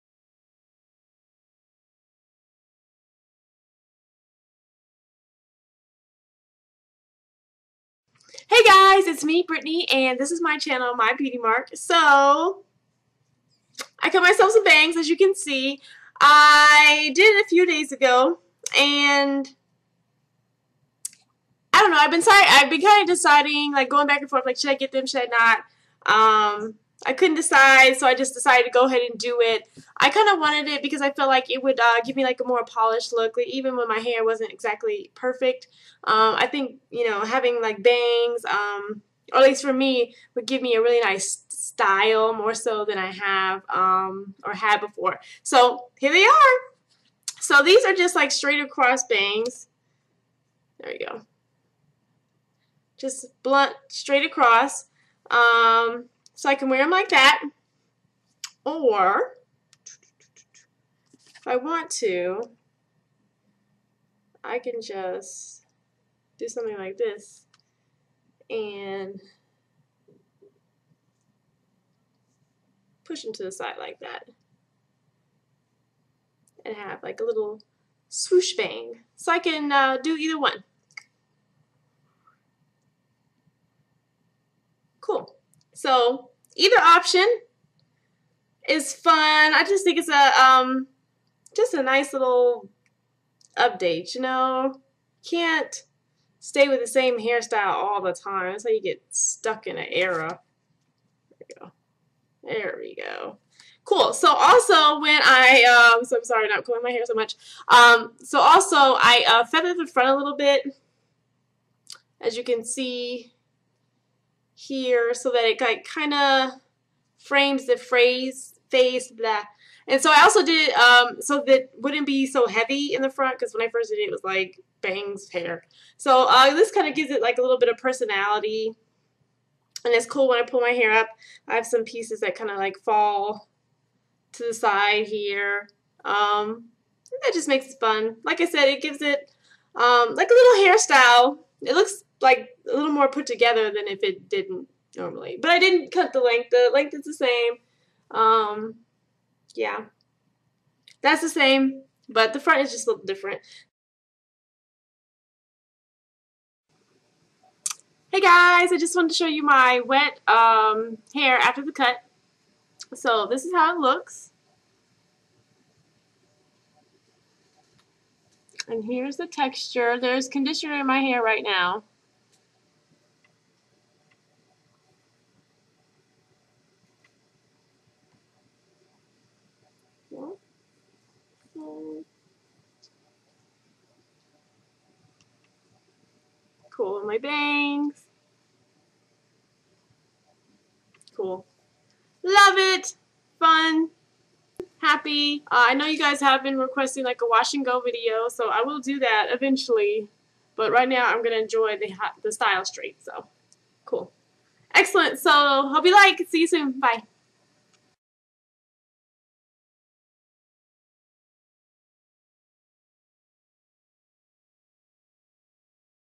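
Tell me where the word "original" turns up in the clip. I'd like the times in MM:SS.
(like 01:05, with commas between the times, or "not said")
not said.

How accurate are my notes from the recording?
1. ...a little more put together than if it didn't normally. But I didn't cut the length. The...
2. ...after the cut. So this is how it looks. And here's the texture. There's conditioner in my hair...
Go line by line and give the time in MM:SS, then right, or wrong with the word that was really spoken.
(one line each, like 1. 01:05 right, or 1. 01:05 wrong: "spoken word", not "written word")
1. 02:22 right
2. 02:41 right.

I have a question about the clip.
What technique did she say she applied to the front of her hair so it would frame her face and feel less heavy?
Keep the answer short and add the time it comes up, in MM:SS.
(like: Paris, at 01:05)
feathered, at 01:49.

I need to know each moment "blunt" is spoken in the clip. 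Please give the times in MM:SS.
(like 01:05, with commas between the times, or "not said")
00:53.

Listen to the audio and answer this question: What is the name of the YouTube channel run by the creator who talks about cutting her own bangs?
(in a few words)
My Beauty Mark.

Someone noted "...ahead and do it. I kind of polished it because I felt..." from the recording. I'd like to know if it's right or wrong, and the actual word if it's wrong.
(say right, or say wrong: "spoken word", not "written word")
wrong: "wanted", not "polished".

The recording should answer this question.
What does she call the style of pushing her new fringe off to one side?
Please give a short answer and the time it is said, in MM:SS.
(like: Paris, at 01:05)
swoosh bang, at 01:18.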